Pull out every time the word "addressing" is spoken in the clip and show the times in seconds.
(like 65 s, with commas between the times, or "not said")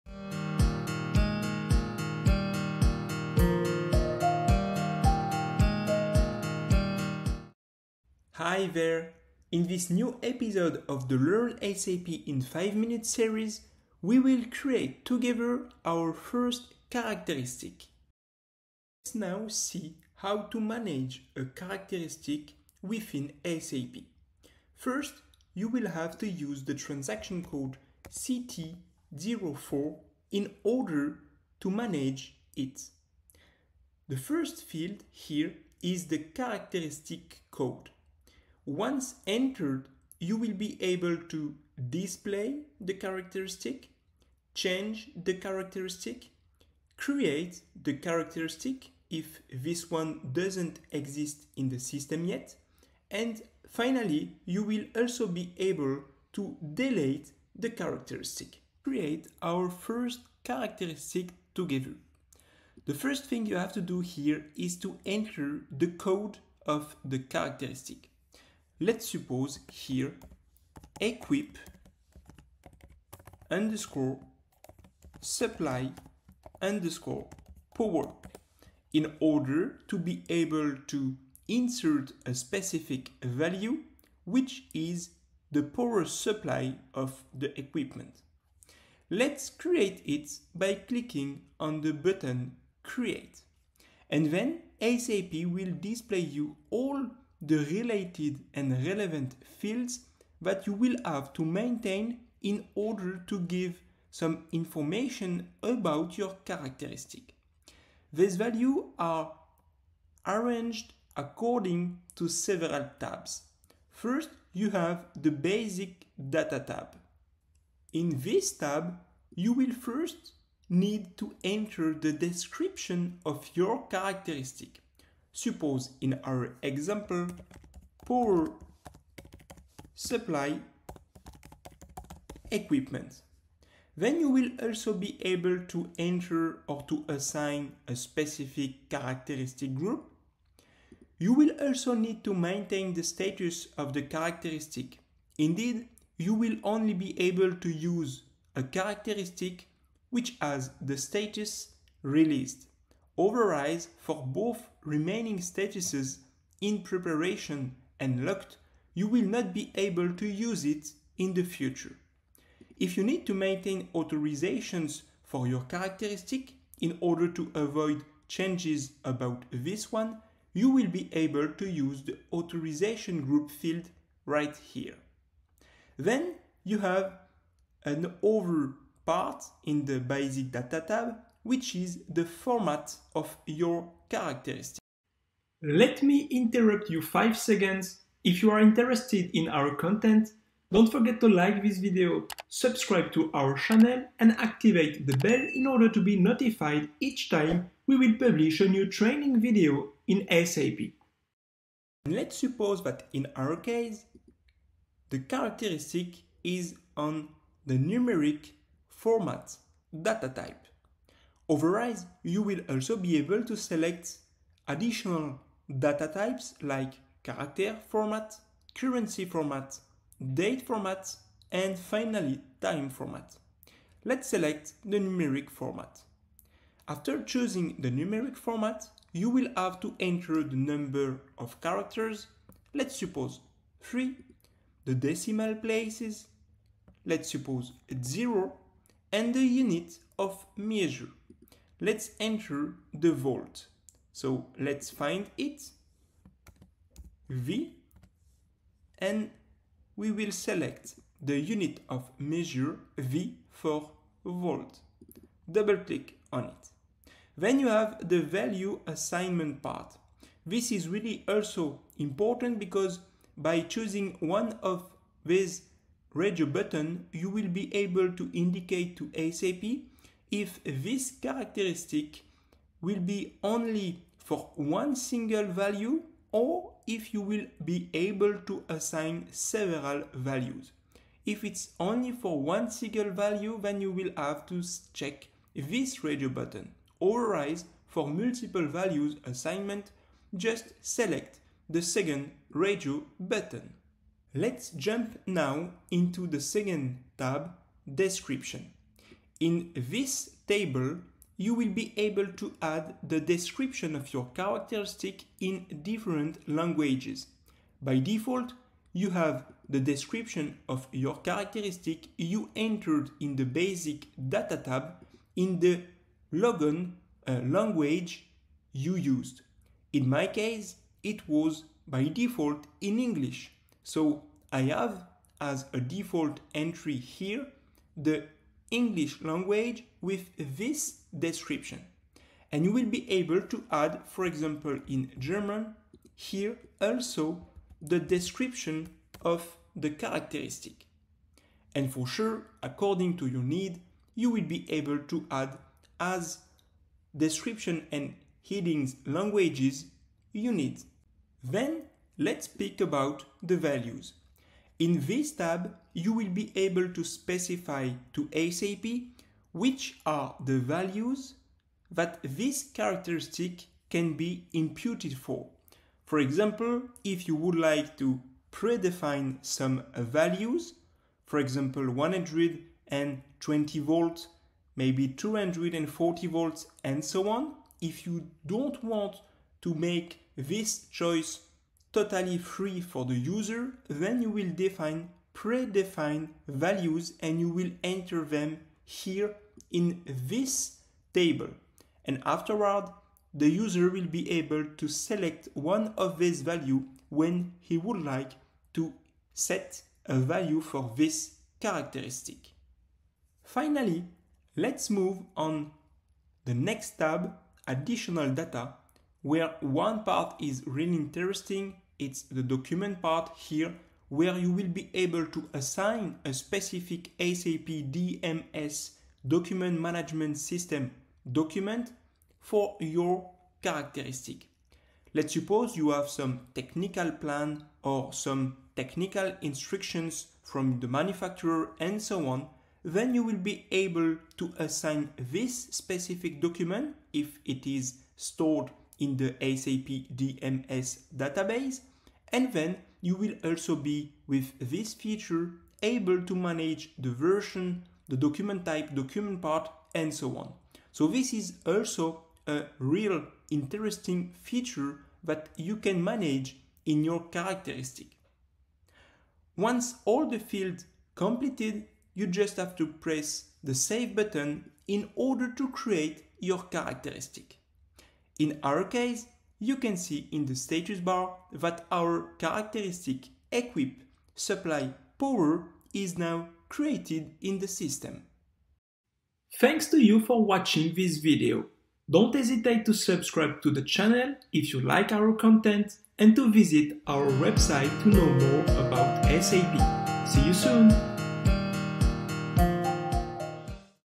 not said.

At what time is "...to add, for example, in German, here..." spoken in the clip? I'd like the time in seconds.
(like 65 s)
333 s.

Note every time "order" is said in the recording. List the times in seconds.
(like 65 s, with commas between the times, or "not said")
30 s, 79 s, 102 s, 166 s, 195 s, 465 s.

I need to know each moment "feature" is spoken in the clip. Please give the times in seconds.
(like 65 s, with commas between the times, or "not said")
444 s, 454 s.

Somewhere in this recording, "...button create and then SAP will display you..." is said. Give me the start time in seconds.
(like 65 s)
91 s.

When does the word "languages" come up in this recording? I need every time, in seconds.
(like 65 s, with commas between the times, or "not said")
306 s, 317 s, 329 s, 349 s.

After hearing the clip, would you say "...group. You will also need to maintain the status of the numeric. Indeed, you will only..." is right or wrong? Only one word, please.
wrong.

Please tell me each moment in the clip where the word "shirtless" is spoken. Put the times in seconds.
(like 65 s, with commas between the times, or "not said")
not said.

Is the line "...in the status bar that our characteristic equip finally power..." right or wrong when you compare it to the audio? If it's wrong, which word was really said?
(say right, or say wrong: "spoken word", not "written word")
wrong: "supply", not "finally".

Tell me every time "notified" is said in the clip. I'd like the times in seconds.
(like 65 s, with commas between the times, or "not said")
196 s.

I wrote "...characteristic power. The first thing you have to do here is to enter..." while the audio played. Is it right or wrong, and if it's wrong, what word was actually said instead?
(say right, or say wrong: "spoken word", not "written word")
wrong: "together", not "power".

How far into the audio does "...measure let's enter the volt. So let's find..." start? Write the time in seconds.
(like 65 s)
240 s.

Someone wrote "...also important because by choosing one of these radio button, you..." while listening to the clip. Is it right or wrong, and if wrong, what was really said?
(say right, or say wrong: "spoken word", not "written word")
right.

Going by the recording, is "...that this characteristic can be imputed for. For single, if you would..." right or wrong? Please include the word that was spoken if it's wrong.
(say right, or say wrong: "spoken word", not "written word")
wrong: "example", not "single".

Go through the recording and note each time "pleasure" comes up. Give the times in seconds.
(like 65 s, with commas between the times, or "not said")
not said.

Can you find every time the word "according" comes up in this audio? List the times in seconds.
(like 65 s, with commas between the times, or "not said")
111 s, 342 s.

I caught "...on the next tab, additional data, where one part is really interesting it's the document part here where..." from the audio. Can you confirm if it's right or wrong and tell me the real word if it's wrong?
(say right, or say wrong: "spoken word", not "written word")
right.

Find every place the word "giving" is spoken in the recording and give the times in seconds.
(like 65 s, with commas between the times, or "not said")
not said.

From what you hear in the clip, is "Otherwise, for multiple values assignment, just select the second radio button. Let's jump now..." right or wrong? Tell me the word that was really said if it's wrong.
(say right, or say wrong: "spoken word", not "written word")
right.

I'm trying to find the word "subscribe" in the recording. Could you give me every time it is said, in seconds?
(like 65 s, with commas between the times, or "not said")
192 s, 482 s.